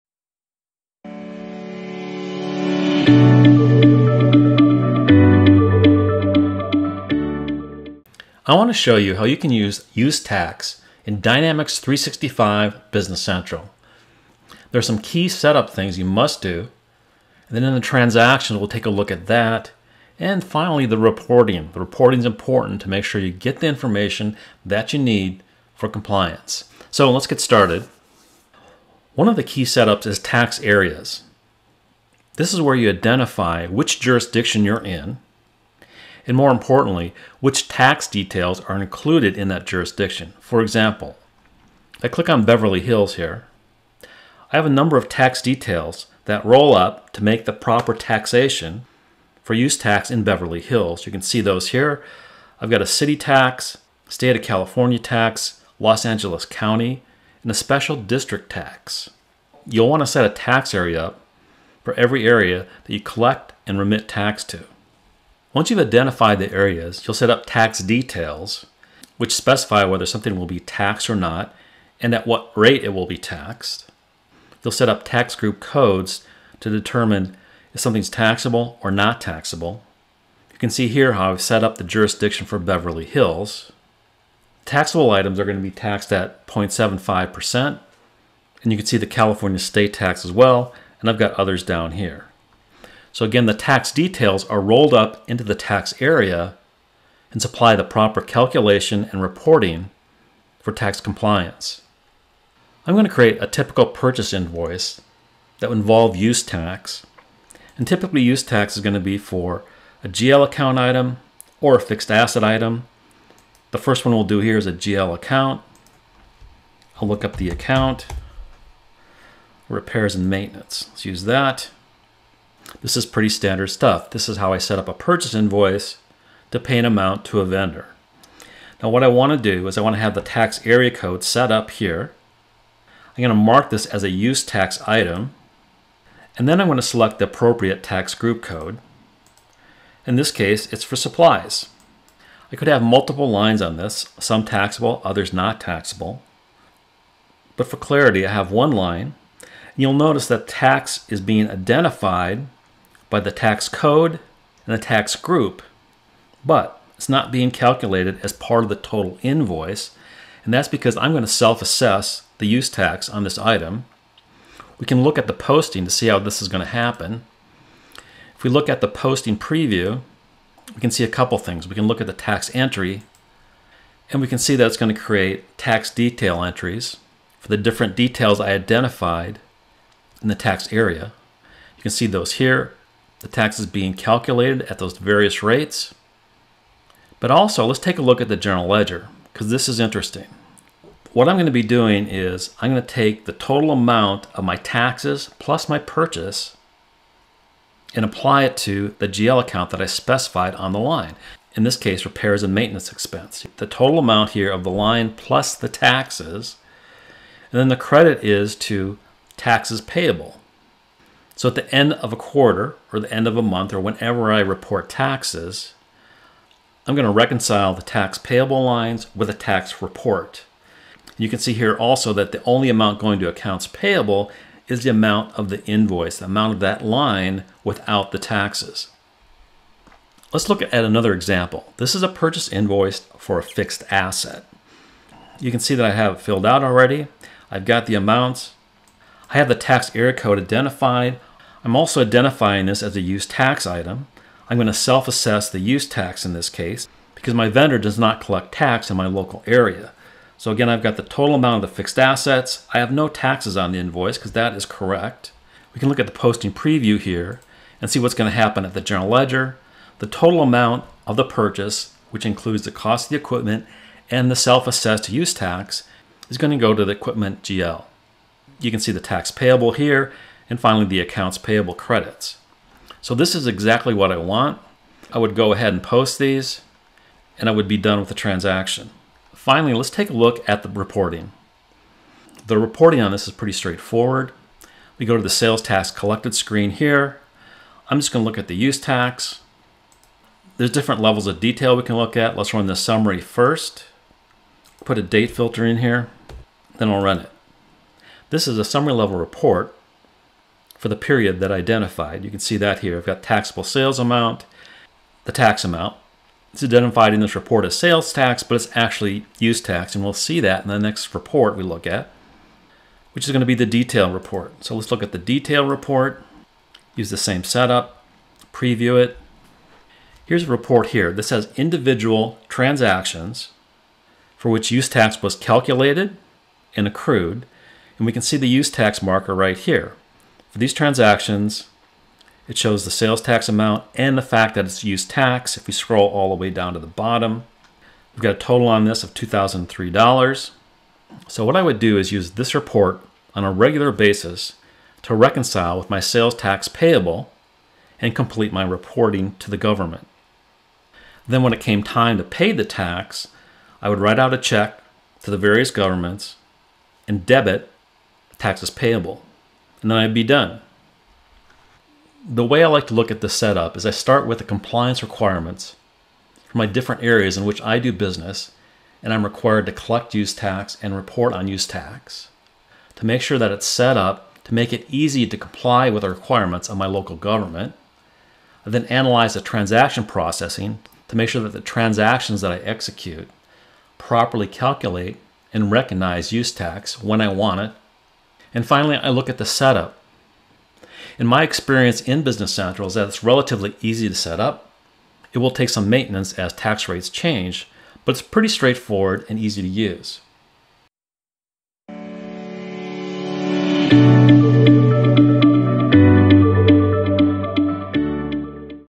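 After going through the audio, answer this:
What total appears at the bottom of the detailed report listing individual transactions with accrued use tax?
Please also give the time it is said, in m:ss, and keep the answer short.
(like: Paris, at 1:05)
$2,003, at 5:39.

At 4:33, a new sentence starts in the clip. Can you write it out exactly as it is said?
So this is exactly what I want.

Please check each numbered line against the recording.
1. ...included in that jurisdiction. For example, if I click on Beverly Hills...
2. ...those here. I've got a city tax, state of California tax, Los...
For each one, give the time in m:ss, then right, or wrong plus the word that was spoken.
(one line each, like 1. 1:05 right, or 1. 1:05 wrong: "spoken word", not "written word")
1. 0:38 right
2. 0:51 right.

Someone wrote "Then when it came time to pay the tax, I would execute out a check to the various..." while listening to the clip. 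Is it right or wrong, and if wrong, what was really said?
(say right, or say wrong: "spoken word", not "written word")
wrong: "write", not "execute".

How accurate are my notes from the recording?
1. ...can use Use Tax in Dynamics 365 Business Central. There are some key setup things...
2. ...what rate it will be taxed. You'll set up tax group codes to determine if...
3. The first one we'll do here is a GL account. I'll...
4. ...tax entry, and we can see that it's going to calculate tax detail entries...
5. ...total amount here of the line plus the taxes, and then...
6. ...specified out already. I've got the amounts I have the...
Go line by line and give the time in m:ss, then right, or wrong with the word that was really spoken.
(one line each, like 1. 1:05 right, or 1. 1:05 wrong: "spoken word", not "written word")
1. 0:09 right
2. 1:12 right
3. 1:53 right
4. 2:52 wrong: "create", not "calculate"
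5. 3:23 right
6. 3:56 wrong: "filled", not "specified".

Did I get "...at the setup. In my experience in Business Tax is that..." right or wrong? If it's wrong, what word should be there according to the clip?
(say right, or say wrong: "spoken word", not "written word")
wrong: "Central", not "Tax".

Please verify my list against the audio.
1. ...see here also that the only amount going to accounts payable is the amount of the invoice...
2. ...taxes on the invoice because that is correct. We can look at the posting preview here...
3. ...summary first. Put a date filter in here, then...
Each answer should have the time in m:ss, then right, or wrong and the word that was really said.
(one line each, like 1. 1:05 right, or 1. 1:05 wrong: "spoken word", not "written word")
1. 3:41 right
2. 4:13 right
3. 4:52 right.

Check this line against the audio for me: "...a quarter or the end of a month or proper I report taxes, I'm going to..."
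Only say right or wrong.
wrong.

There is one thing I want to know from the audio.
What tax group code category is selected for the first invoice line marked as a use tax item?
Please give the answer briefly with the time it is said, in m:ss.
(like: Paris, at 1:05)
supplies, at 2:20.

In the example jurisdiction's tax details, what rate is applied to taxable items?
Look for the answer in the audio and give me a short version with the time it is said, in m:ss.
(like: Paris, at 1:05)
0.75%, at 1:26.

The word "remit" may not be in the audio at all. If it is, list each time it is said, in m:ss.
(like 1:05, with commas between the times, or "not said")
1:03.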